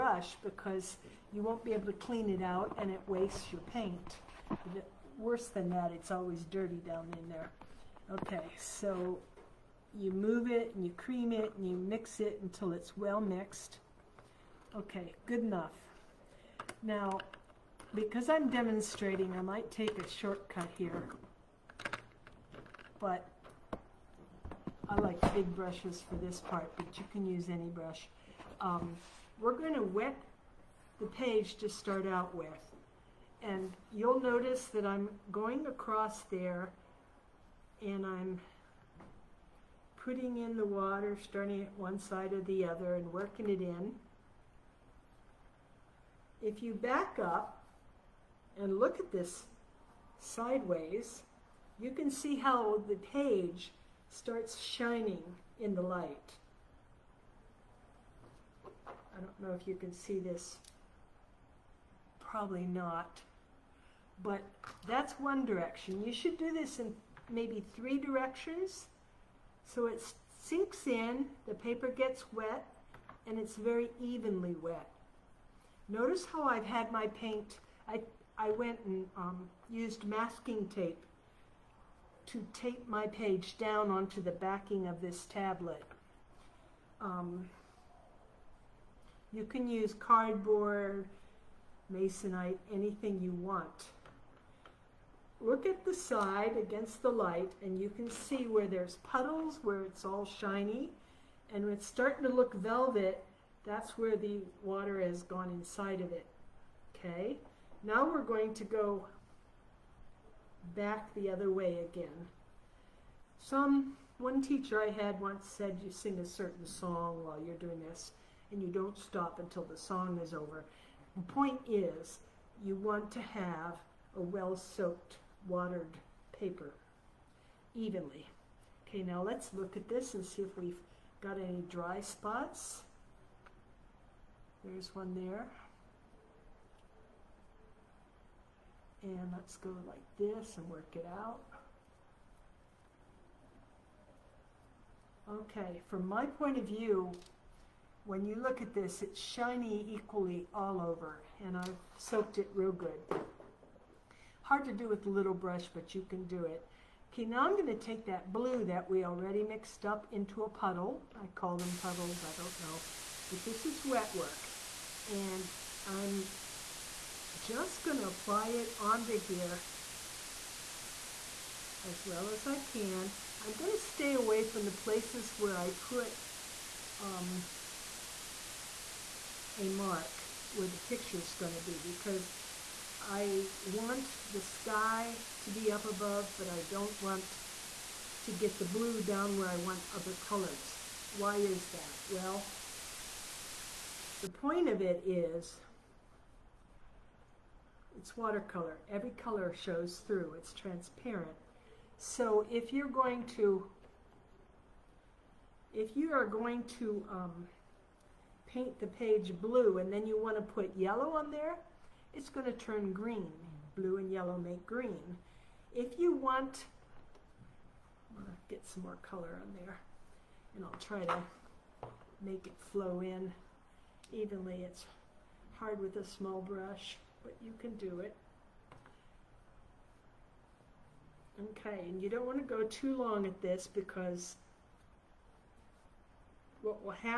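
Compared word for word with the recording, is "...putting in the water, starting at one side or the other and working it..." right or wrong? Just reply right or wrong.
right.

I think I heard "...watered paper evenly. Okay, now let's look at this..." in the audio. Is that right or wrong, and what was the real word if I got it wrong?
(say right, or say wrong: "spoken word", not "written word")
right.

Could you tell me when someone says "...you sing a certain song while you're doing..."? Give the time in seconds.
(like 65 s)
115 s.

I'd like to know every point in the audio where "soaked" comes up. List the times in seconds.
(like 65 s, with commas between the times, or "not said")
124 s, 151 s.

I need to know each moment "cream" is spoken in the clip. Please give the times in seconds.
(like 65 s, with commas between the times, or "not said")
10 s.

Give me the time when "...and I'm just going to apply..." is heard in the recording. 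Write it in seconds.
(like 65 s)
165 s.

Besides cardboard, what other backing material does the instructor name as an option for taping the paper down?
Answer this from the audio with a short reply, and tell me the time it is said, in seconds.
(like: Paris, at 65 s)
Masonite, at 91 s.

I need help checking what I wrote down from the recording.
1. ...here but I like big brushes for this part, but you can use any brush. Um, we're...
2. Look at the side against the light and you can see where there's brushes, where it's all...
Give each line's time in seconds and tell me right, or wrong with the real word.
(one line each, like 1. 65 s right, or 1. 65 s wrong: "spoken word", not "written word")
1. 20 s right
2. 95 s wrong: "puddles", not "brushes".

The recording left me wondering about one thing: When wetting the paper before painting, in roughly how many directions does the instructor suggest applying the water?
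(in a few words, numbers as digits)
3.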